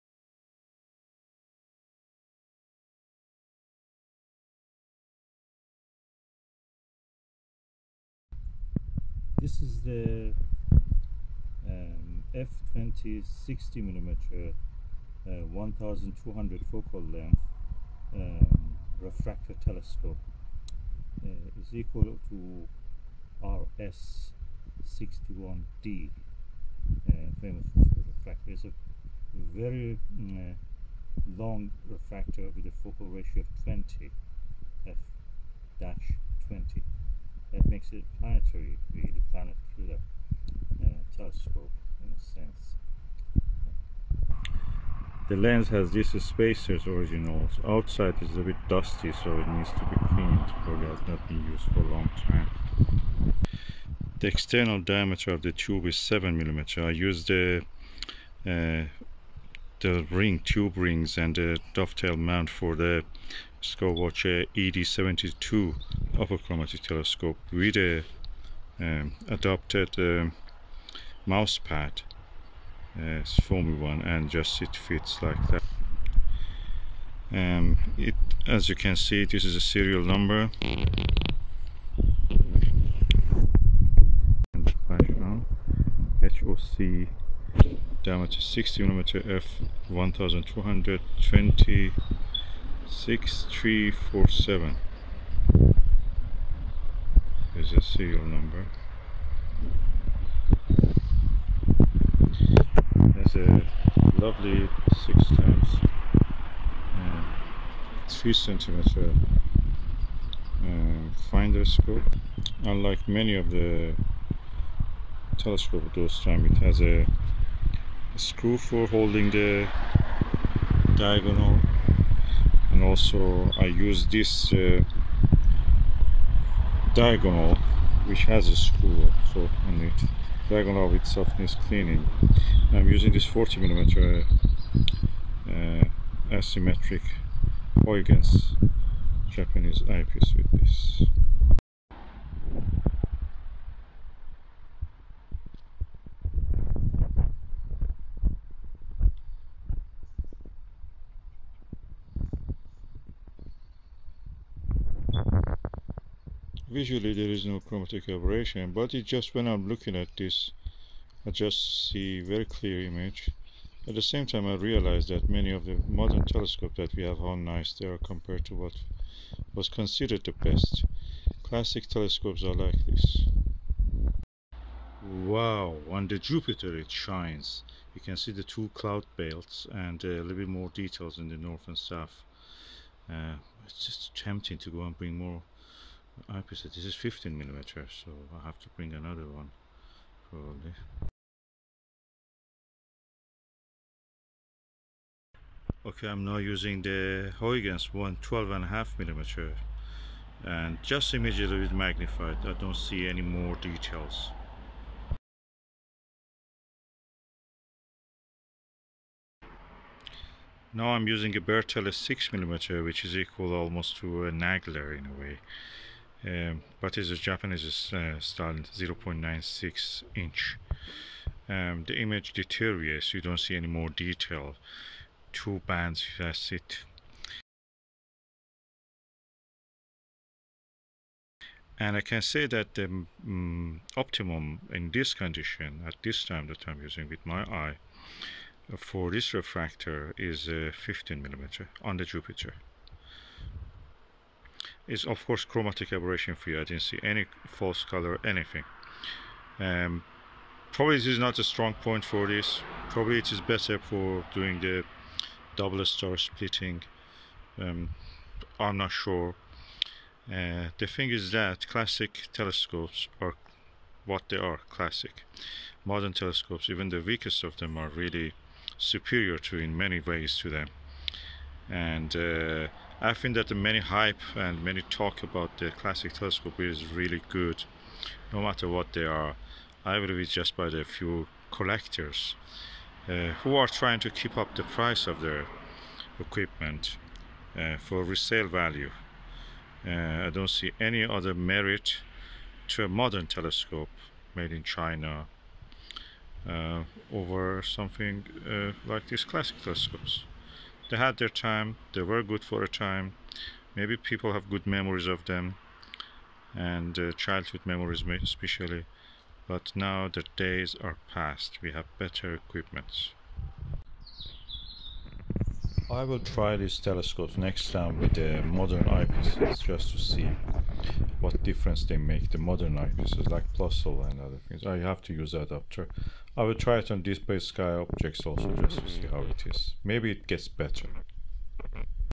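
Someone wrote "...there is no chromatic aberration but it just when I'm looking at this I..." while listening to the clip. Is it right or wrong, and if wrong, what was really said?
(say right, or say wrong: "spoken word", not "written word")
right.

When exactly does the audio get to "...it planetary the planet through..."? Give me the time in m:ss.
0:37.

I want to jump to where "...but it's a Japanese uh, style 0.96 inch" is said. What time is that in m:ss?
3:36.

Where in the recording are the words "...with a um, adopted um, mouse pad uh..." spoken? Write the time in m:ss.
1:07.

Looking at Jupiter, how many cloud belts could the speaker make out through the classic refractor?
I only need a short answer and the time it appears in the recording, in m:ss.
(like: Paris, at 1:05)
2, at 2:58.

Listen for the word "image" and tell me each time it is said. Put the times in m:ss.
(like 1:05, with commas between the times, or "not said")
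2:42, 3:41.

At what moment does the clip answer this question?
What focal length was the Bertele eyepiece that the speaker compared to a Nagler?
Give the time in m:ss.
3:31.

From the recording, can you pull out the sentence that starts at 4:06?
I didn't see any false color, anything.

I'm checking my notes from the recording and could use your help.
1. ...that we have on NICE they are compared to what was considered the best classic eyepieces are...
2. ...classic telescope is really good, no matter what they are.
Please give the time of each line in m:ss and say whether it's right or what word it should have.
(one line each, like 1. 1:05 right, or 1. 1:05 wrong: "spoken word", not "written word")
1. 2:46 wrong: "telescopes", not "eyepieces"
2. 4:35 right.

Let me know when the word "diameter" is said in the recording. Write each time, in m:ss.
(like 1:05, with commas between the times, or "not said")
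0:54, 1:28.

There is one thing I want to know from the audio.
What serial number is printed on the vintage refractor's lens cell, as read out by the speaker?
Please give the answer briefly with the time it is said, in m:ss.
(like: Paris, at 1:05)
6347, at 1:32.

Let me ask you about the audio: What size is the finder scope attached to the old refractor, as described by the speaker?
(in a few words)
6 x 3 cm.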